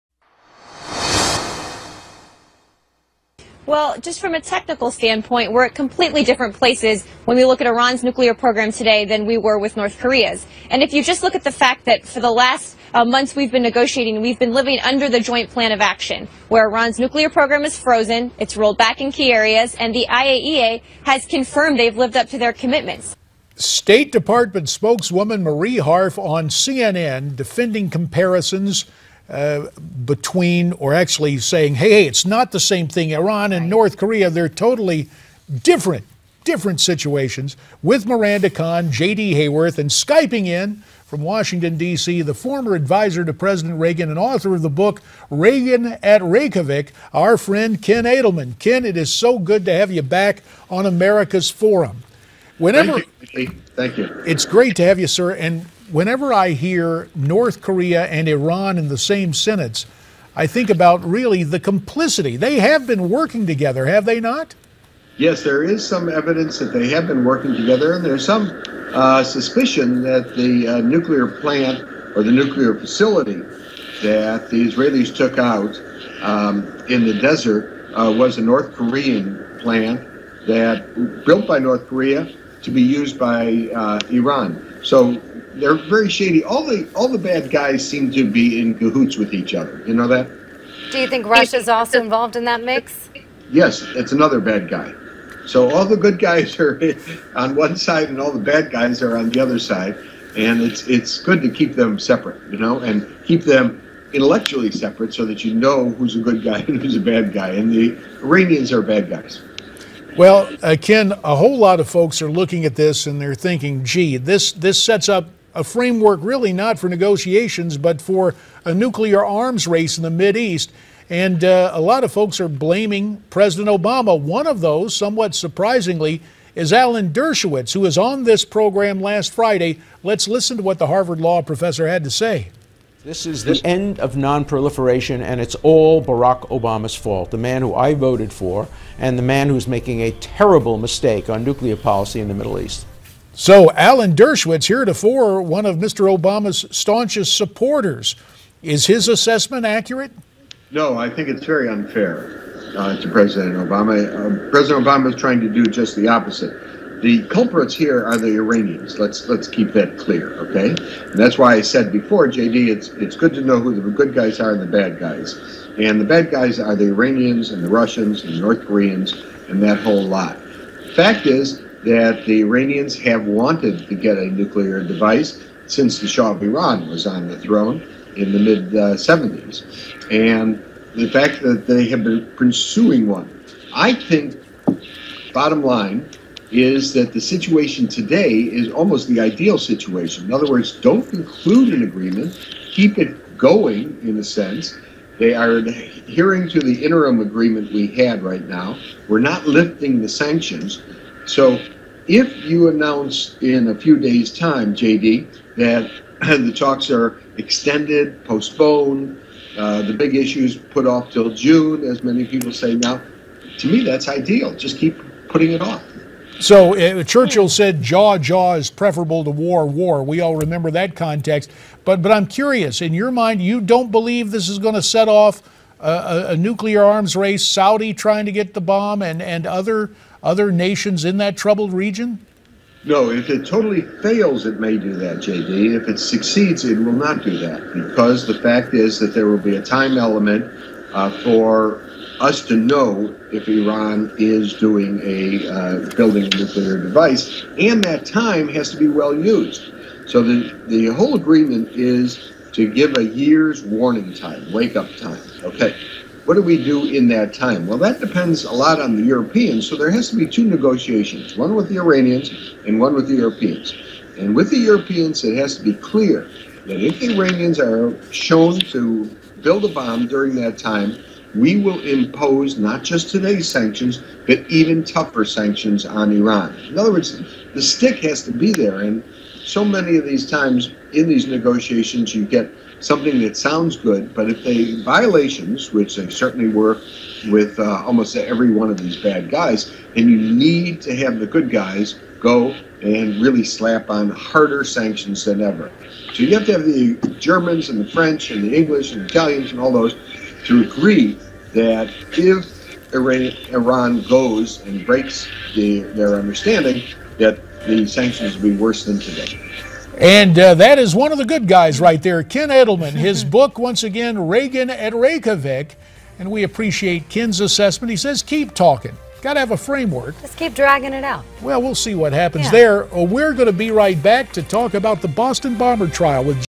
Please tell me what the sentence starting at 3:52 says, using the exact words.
No, if it totally fails, it may do that, JD.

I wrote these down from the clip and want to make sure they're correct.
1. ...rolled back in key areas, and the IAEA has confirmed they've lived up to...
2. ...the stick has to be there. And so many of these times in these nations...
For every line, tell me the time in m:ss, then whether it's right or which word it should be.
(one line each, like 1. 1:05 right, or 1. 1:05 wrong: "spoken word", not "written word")
1. 0:18 right
2. 4:37 wrong: "negotiations", not "nations".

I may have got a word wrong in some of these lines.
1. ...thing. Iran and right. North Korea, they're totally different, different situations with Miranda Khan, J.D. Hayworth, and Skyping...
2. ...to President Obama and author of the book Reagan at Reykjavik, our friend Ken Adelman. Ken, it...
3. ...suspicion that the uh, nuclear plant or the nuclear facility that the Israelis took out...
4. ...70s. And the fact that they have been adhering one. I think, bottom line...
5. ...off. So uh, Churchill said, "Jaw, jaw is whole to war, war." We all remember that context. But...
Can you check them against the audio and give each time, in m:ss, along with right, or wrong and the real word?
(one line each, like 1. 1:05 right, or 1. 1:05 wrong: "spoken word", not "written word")
1. 0:32 right
2. 0:43 wrong: "Reagan", not "Obama"
3. 1:09 right
4. 2:58 wrong: "pursuing", not "adhering"
5. 3:35 wrong: "preferable", not "whole".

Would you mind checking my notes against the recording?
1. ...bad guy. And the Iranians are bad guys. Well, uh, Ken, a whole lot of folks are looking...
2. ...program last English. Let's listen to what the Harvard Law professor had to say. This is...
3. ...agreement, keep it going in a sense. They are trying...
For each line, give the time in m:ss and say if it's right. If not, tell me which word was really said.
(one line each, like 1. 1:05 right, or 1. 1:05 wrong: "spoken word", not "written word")
1. 1:47 right
2. 2:08 wrong: "Friday", not "English"
3. 3:11 wrong: "adhering", not "trying".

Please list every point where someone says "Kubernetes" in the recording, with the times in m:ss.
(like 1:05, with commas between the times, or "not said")
not said.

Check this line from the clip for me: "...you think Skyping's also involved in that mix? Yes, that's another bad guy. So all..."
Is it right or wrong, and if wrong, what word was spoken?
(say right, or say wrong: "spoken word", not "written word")
wrong: "Russia", not "Skyping".